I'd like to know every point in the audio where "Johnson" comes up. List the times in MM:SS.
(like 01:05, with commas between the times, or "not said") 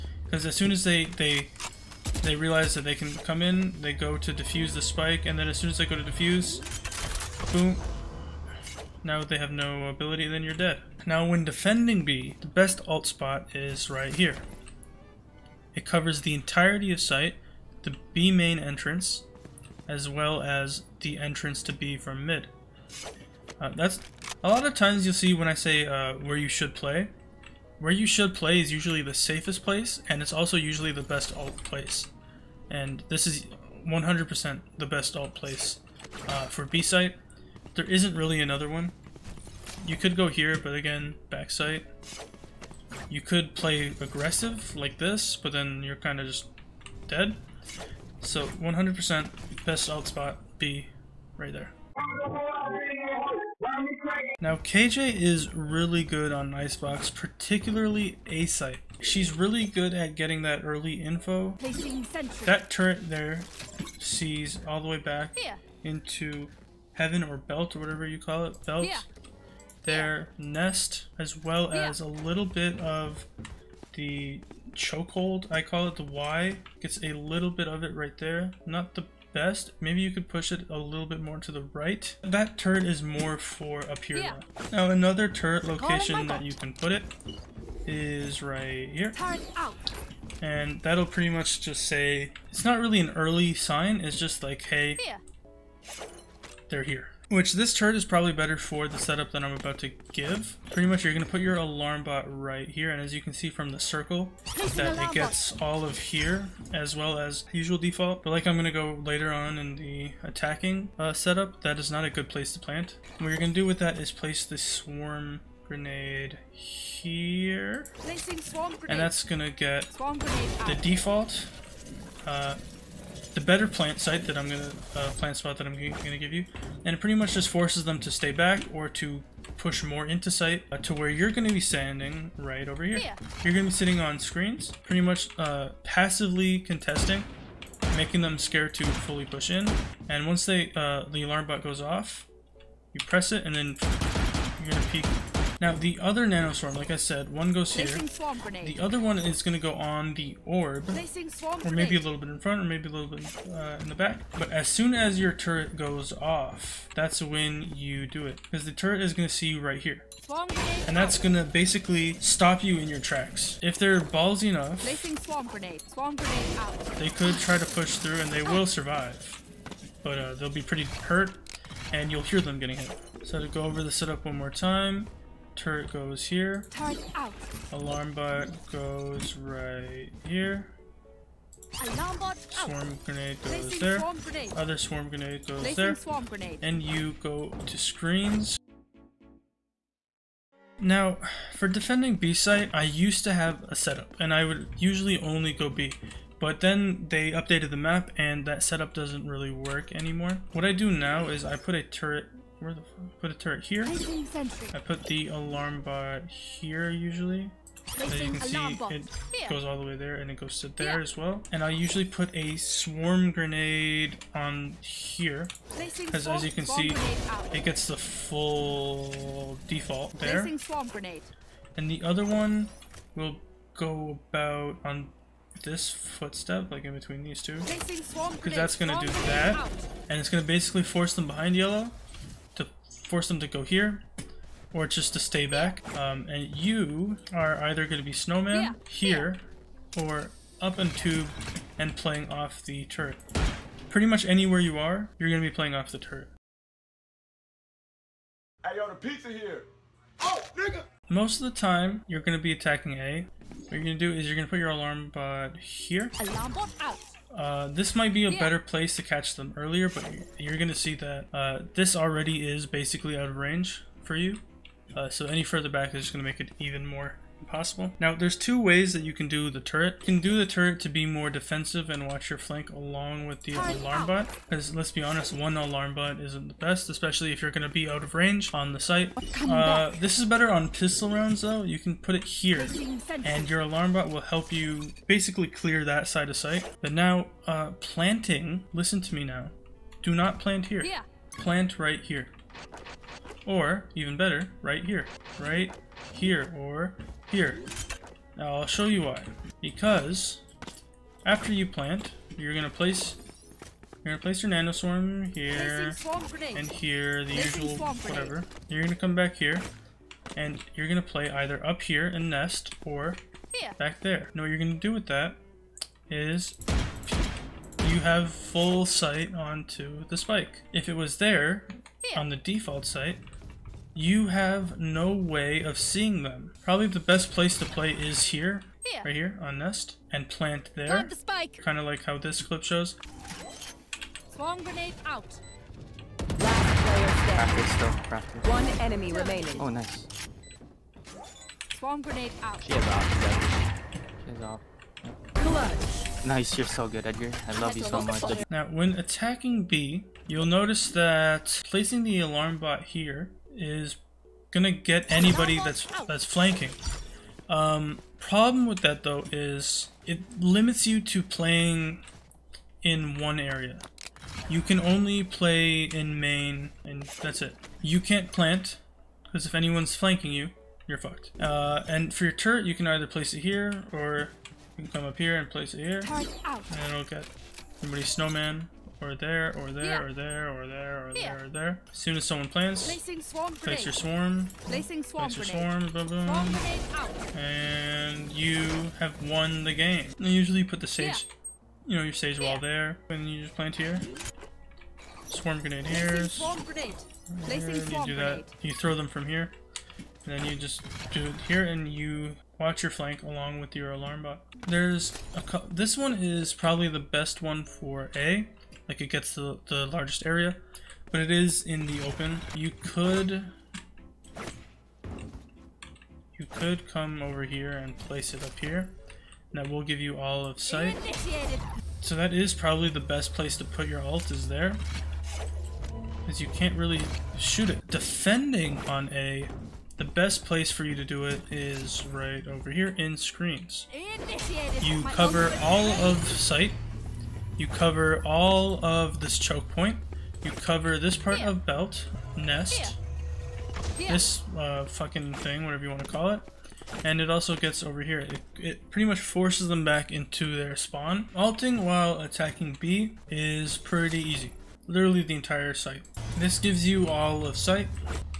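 not said.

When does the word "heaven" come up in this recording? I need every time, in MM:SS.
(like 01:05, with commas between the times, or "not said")
01:06.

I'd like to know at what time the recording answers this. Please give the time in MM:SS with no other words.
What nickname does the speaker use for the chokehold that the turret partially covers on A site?
01:15.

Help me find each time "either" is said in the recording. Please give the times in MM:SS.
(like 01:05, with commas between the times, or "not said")
03:57, 05:11, 06:12.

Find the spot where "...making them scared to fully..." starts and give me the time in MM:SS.
02:17.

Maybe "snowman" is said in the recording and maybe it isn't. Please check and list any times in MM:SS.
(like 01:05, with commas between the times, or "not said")
03:58, 06:18.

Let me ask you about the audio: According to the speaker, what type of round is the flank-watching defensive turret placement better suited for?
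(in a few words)
Pistol rounds.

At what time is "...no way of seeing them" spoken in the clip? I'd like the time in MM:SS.
05:24.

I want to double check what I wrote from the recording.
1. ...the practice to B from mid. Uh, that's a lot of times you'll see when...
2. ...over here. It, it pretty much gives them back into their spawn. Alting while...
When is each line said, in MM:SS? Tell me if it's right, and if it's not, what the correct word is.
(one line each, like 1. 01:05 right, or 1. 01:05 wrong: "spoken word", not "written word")
1. 00:21 wrong: "entrance", not "practice"
2. 07:27 wrong: "forces", not "gives".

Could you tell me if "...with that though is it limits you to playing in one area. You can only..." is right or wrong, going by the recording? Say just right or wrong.
right.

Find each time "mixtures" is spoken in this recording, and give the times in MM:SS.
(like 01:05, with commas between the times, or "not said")
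not said.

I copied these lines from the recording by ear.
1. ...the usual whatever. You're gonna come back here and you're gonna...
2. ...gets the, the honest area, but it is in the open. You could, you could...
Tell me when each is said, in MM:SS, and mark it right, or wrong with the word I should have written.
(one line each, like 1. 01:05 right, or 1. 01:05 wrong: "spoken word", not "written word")
1. 05:07 right
2. 06:49 wrong: "largest", not "honest".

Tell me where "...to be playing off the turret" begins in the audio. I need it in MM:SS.
04:05.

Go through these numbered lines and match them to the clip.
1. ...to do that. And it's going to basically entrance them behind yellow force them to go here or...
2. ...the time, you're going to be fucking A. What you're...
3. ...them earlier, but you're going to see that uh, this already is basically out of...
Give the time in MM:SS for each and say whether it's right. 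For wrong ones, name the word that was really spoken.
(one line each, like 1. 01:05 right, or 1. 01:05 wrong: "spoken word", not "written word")
1. 03:48 wrong: "force", not "entrance"
2. 04:11 wrong: "attacking", not "fucking"
3. 04:19 right.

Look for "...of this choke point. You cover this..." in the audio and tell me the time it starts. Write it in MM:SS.
07:18.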